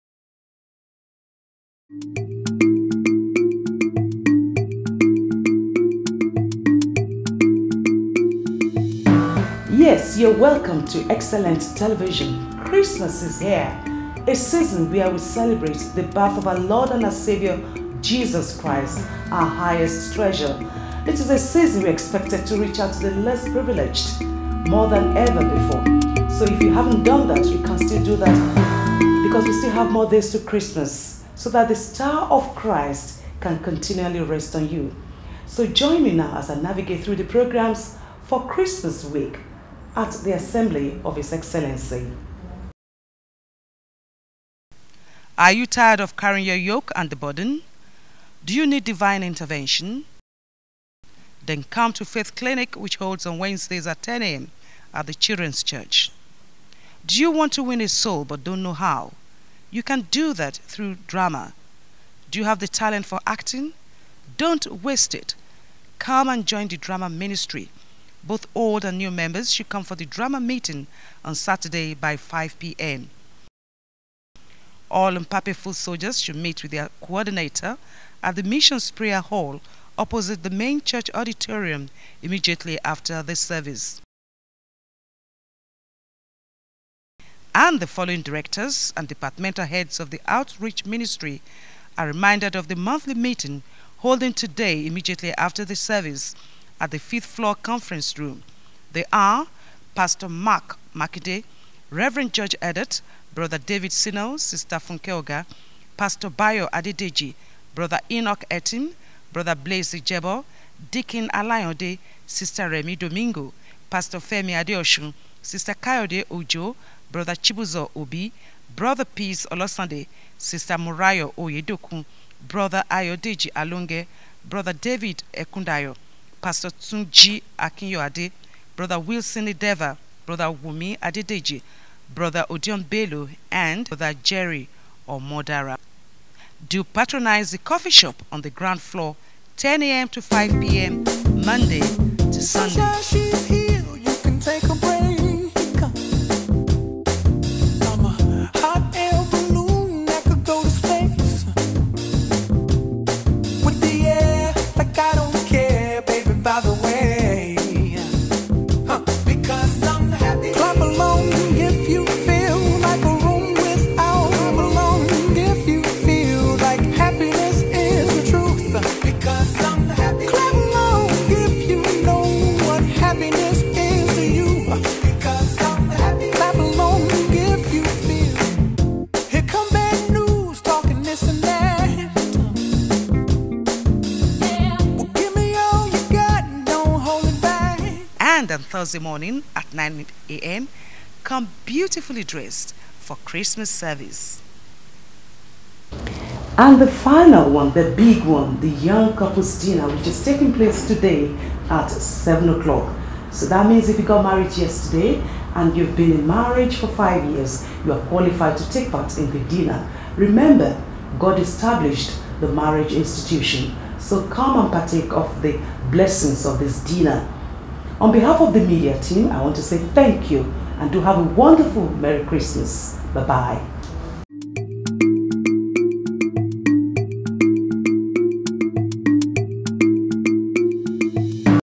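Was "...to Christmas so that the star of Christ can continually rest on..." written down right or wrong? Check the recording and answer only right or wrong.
right.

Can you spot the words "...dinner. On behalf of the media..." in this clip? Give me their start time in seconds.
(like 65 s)
216 s.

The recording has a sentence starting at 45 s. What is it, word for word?
Are you tired of carrying your yoke and the burden?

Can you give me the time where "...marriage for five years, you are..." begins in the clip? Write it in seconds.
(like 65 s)
206 s.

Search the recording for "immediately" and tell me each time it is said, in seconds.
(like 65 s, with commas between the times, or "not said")
82 s, 94 s.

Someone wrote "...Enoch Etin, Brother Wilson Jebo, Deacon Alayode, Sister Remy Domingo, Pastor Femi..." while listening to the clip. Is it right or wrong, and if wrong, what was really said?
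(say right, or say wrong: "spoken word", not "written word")
wrong: "Blaise", not "Wilson".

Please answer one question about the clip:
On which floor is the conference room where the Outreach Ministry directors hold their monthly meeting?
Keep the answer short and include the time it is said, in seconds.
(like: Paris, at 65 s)
Fifth floor, at 96 s.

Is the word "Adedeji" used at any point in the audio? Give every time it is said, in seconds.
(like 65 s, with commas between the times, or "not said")
106 s, 131 s.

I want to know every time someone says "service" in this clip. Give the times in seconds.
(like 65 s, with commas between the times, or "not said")
83 s, 95 s, 193 s.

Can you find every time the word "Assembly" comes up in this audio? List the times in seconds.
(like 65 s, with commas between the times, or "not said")
40 s.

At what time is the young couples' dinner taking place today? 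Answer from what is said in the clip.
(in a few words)
7 o'clock.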